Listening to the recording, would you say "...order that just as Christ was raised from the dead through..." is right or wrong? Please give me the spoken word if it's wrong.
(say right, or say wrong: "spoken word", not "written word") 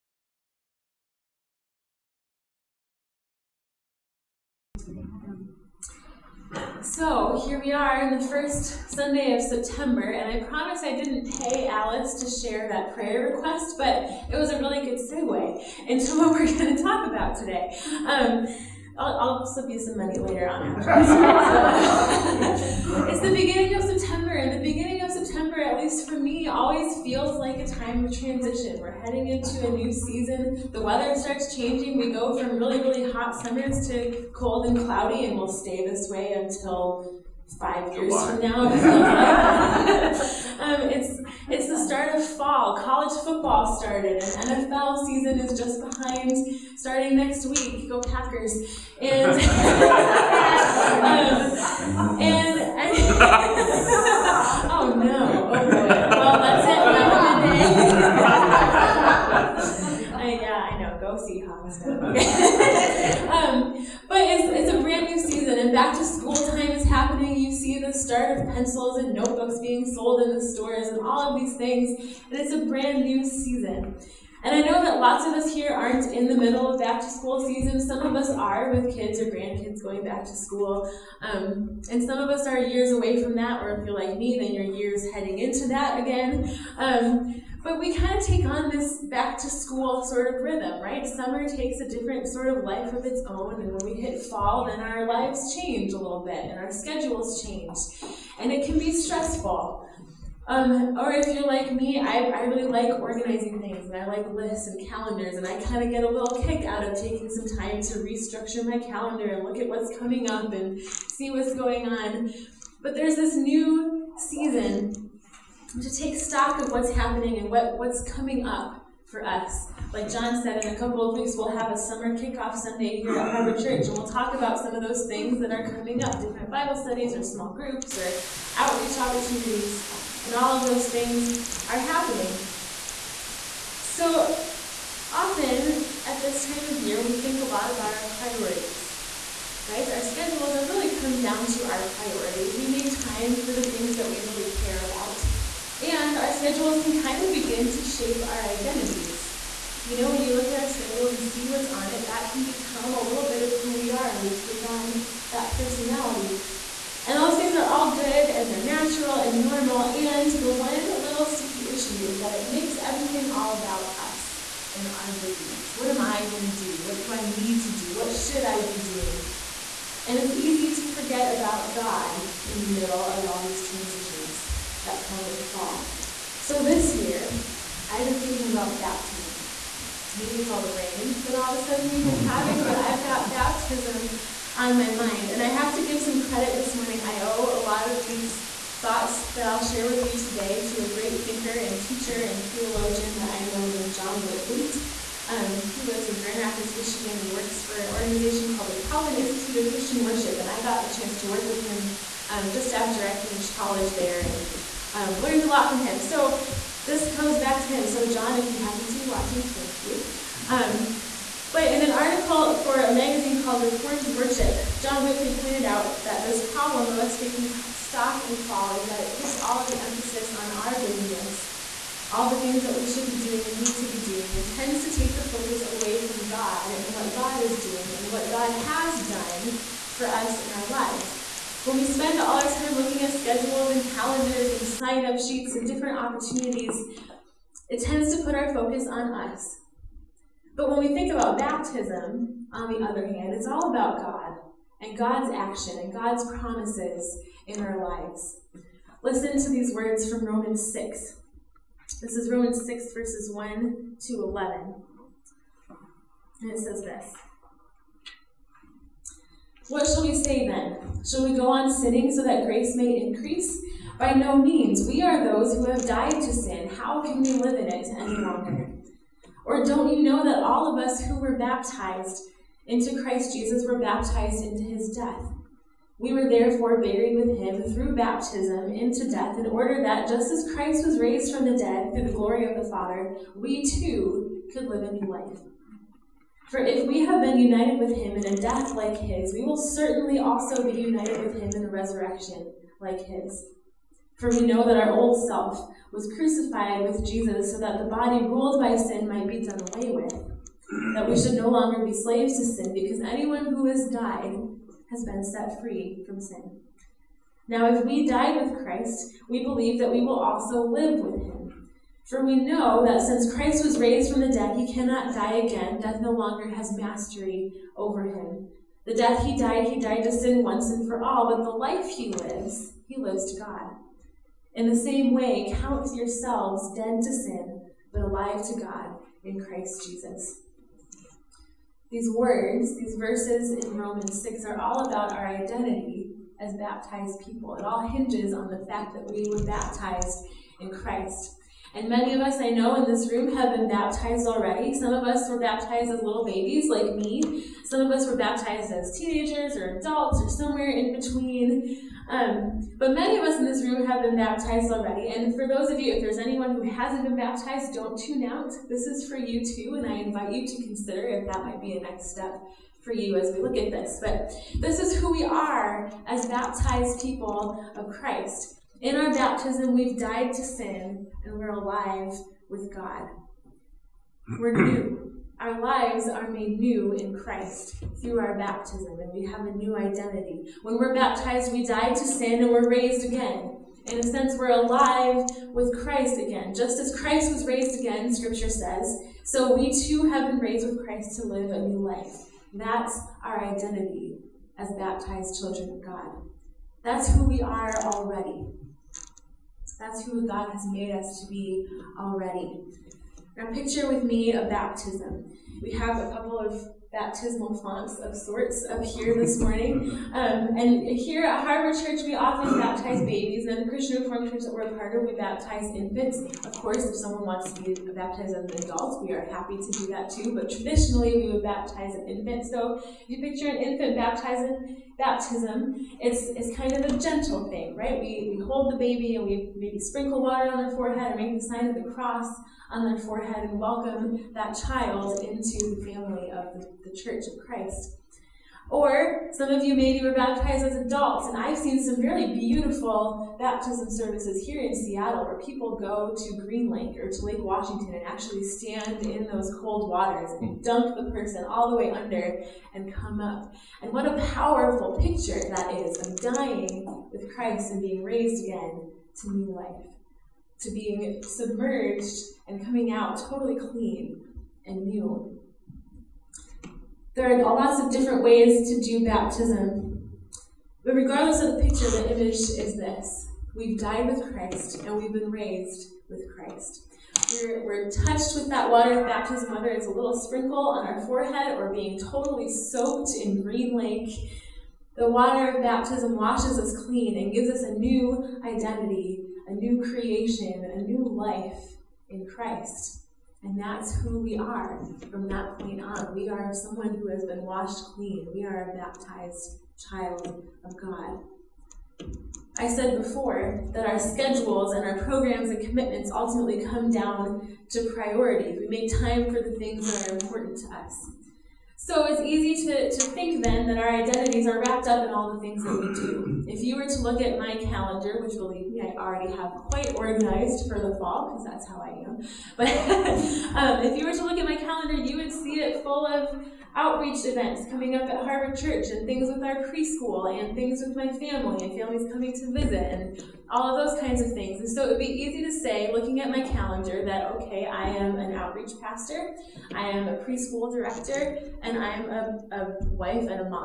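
right.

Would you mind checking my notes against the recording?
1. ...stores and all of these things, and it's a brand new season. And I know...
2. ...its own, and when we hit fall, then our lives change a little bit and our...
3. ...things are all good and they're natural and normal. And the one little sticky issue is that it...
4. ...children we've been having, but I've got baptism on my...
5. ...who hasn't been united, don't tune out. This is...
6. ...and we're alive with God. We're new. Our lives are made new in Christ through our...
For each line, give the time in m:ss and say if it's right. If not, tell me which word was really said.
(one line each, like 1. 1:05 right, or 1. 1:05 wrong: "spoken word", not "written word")
1. 1:10 right
2. 1:33 right
3. 2:37 right
4. 3:01 wrong: "sudden", not "children"
5. 5:56 wrong: "baptized", not "united"
6. 6:11 right.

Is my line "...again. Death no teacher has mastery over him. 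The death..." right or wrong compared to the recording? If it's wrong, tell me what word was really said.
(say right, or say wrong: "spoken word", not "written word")
wrong: "longer", not "teacher".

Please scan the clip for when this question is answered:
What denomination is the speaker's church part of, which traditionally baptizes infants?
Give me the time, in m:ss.
6:53.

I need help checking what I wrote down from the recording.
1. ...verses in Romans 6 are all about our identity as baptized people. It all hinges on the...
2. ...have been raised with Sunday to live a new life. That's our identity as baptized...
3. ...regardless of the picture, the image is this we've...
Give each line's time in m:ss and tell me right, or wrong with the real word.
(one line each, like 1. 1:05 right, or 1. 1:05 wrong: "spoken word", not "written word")
1. 5:32 right
2. 6:30 wrong: "Christ", not "Sunday"
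3. 7:50 right.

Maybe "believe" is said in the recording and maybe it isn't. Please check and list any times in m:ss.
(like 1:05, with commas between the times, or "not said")
5:09, 8:38.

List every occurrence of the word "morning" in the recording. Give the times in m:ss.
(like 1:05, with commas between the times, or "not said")
3:06, 6:49.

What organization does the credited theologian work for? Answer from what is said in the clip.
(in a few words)
Calvin Institute of Christian Worship.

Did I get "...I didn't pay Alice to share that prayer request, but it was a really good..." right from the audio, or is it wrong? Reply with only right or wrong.
right.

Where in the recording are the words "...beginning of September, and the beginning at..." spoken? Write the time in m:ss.
0:23.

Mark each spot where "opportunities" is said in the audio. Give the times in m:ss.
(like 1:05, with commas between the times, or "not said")
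2:08, 3:55.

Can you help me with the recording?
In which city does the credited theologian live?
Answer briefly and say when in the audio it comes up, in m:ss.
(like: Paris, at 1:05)
Grand Rapids, Michigan, at 3:16.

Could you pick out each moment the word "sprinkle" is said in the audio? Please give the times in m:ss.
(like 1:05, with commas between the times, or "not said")
7:09, 8:00.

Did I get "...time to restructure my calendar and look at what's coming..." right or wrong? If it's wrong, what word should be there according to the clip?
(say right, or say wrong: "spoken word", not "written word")
right.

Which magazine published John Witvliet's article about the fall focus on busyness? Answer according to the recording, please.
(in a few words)
Reformed Worship.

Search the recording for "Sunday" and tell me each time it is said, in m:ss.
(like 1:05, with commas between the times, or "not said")
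0:08, 2:02.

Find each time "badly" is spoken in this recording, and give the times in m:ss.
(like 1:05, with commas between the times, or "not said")
not said.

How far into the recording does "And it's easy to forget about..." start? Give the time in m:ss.
2:50.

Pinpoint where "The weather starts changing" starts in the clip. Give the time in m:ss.
0:30.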